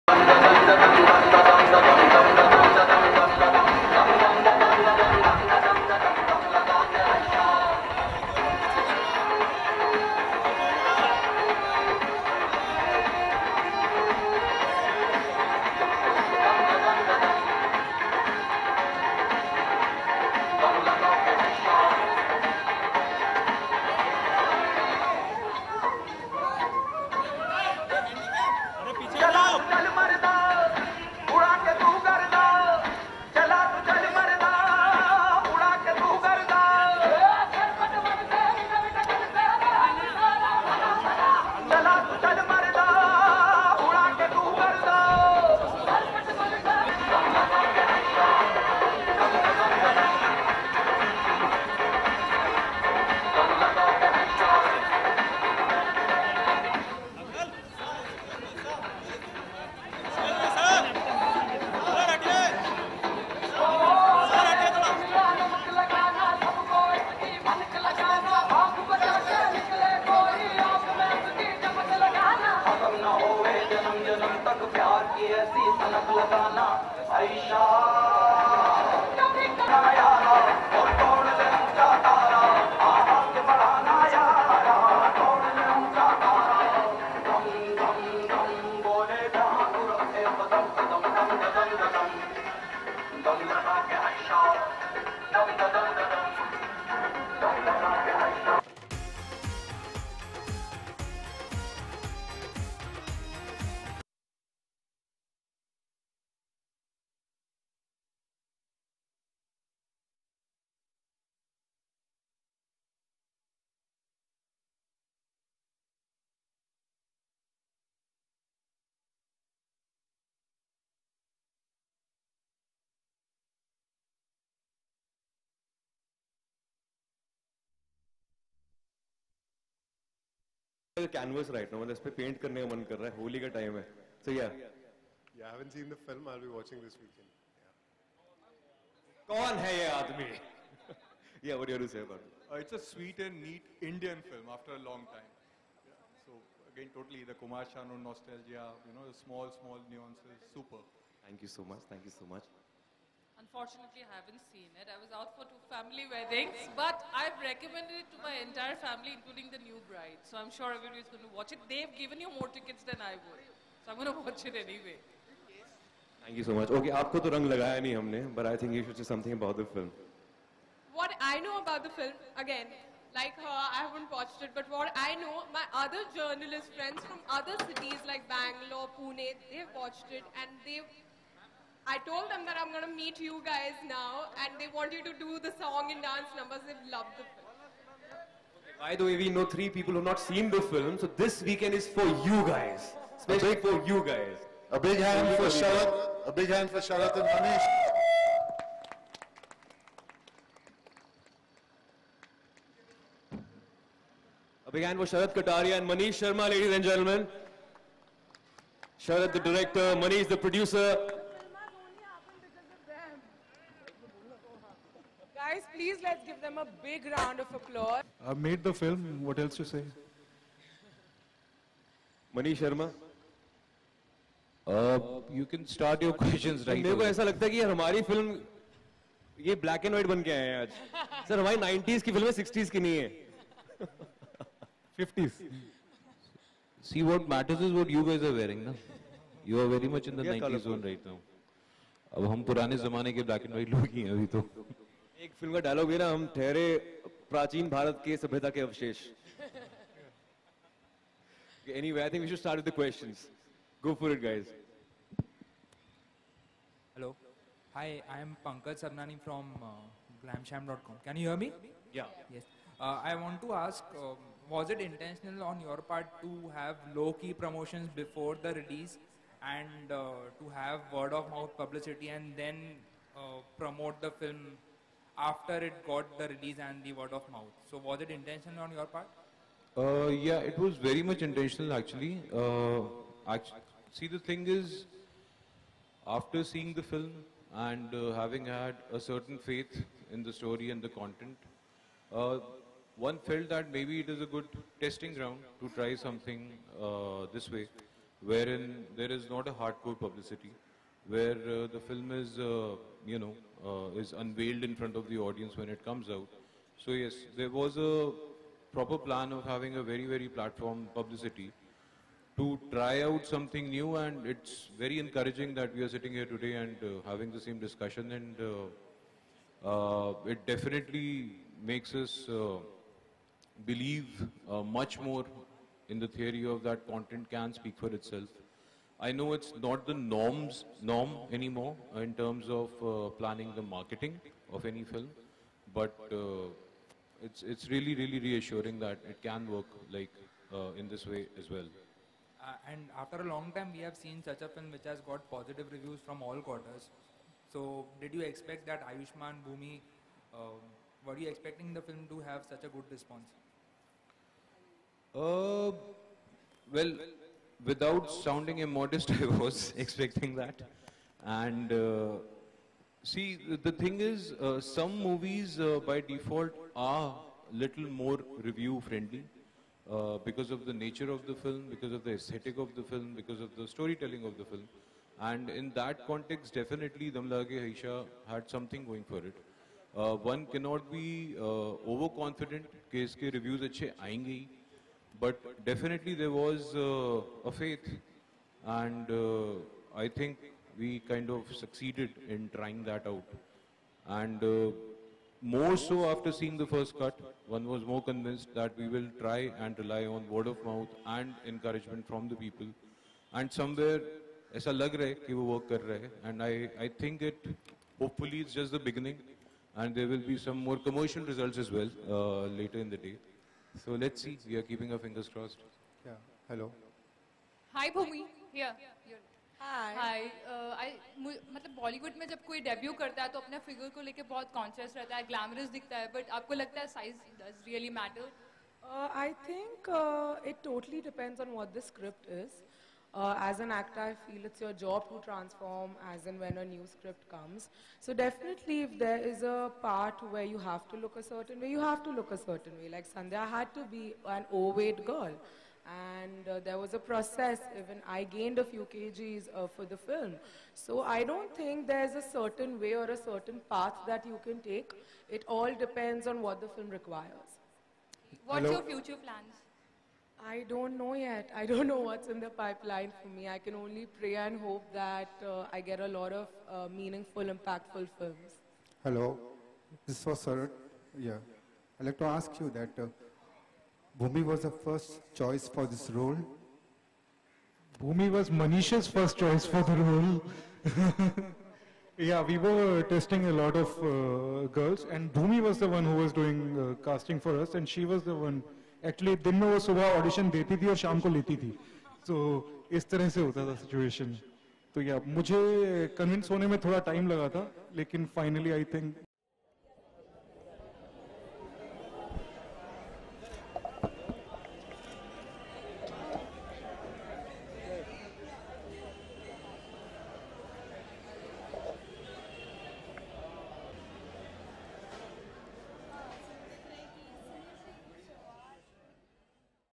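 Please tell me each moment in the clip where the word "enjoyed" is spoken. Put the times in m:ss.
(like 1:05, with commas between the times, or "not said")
not said.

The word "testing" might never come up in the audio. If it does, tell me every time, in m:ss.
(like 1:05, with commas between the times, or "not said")
4:54, 8:03.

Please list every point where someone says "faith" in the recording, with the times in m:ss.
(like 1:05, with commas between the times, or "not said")
4:49, 6:27.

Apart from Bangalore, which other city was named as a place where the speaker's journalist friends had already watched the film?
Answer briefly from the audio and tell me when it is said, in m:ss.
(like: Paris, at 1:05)
Pune, at 2:58.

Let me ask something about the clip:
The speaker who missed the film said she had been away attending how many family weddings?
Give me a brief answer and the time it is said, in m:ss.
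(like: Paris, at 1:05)
2, at 2:35.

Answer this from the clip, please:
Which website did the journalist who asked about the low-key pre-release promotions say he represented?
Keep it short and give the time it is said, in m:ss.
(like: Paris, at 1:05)
glamsham.com, at 4:20.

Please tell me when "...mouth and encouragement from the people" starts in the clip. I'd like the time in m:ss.
6:40.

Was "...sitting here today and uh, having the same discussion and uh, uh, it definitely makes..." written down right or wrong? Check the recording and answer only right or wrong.
right.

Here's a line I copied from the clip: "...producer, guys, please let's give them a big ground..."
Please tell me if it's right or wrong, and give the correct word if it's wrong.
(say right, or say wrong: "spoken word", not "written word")
wrong: "round", not "ground".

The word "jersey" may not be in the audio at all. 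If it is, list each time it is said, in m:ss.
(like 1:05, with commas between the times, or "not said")
not said.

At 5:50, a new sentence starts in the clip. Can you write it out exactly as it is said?
Um, were you expecting the film to have such a good response?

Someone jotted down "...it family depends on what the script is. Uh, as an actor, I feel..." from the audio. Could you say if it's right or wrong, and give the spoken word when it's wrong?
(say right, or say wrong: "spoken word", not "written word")
wrong: "totally", not "family".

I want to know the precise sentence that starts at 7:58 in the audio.
Bhumi was Manisha's first choice for the role.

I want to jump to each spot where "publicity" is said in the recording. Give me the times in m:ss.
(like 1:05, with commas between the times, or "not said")
4:59, 5:10.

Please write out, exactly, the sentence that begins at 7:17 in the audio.
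So definitely if there is a part where you have to look a certain way, you have to look a certain way.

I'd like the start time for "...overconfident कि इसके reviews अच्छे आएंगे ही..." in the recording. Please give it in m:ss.
6:21.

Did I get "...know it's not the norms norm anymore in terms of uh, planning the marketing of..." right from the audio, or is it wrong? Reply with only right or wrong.
right.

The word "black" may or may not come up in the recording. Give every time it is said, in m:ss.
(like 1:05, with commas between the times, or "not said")
3:49, 4:03.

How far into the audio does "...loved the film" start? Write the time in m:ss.
3:06.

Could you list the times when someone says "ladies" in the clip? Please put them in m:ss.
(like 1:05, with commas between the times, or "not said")
3:26.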